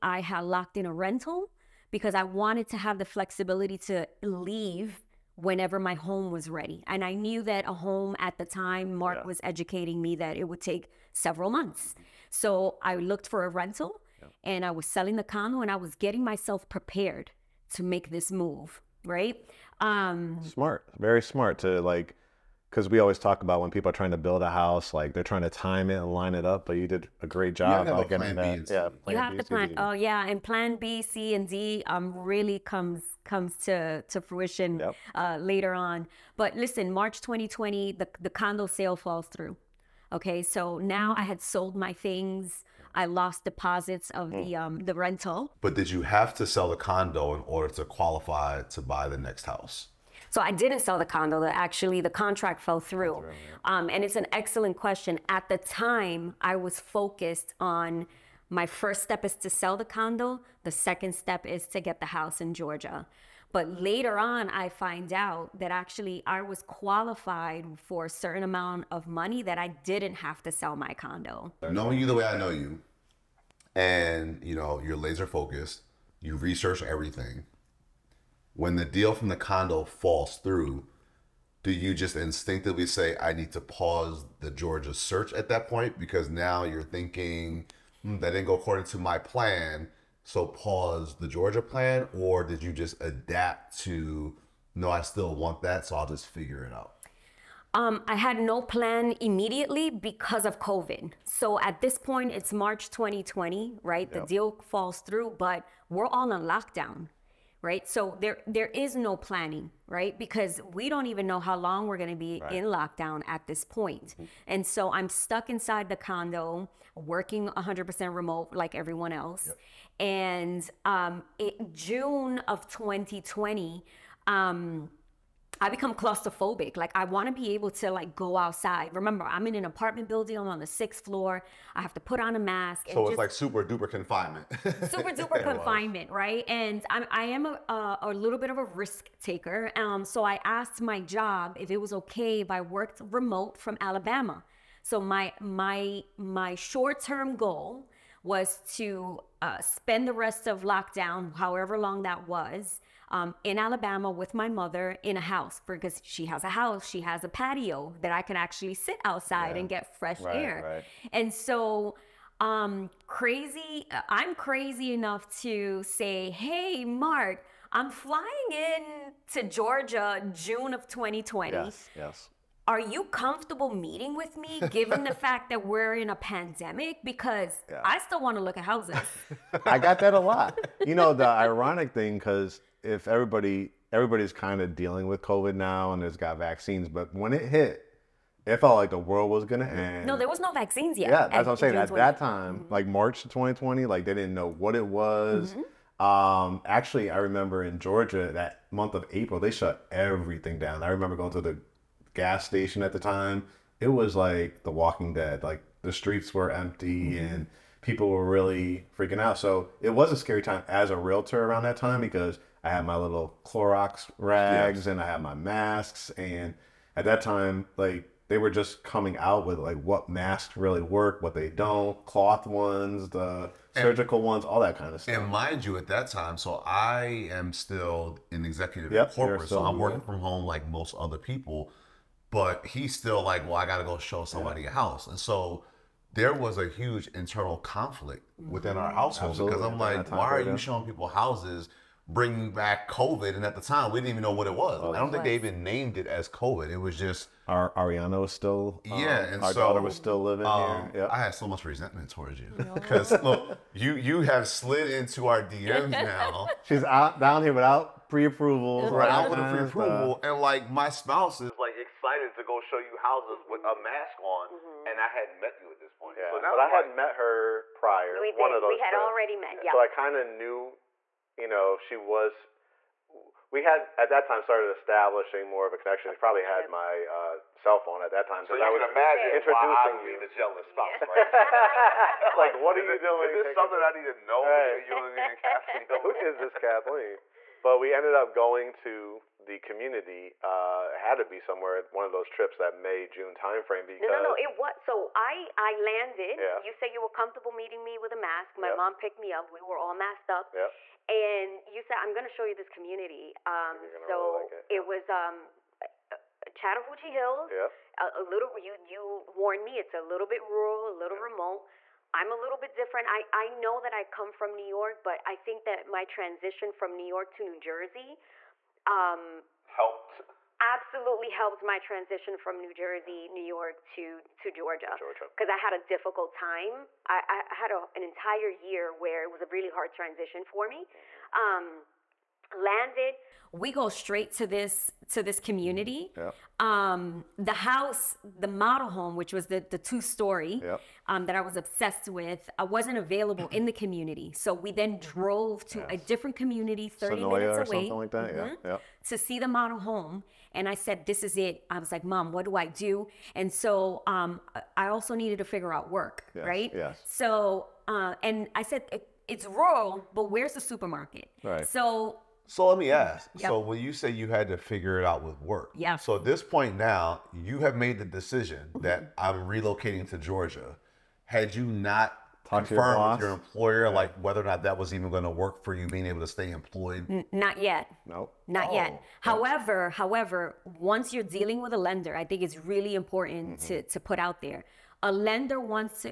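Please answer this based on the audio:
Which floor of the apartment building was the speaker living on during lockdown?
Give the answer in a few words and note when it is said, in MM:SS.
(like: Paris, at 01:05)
sixth floor, at 02:10.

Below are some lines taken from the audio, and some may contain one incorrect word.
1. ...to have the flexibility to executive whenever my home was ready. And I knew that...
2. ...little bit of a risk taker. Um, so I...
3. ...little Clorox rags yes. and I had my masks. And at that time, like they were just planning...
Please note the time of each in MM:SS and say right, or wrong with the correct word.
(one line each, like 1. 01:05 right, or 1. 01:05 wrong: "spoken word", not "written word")
1. 00:02 wrong: "leave", not "executive"
2. 02:18 right
3. 03:32 wrong: "coming", not "planning".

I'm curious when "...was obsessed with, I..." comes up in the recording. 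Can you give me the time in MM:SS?
05:41.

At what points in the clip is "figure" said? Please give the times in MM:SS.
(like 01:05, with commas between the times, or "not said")
01:36, 05:55, 06:04.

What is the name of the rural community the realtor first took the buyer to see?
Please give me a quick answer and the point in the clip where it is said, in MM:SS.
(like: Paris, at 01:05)
Chattahoochee Hills, at 05:06.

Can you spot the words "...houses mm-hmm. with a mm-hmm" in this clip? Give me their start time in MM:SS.
04:22.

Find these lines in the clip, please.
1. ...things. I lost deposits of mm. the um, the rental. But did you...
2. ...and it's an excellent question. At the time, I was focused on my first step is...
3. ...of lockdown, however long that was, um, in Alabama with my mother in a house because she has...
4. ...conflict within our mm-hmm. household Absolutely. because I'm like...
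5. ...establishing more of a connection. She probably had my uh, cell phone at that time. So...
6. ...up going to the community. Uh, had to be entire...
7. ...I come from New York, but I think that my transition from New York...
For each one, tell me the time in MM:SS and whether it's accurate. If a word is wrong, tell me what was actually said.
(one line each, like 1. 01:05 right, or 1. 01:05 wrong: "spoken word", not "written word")
1. 00:41 right
2. 00:53 right
3. 02:30 right
4. 03:57 right
5. 04:34 right
6. 04:48 wrong: "somewhere", not "entire"
7. 05:13 right.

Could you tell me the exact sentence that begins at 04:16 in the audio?
She's out down here without pre-approval, right?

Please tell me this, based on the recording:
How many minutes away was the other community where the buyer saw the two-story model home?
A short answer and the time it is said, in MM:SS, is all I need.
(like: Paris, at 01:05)
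30, at 05:46.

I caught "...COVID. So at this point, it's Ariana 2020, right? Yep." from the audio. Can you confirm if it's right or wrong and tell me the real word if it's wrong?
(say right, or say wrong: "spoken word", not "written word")
wrong: "March", not "Ariana".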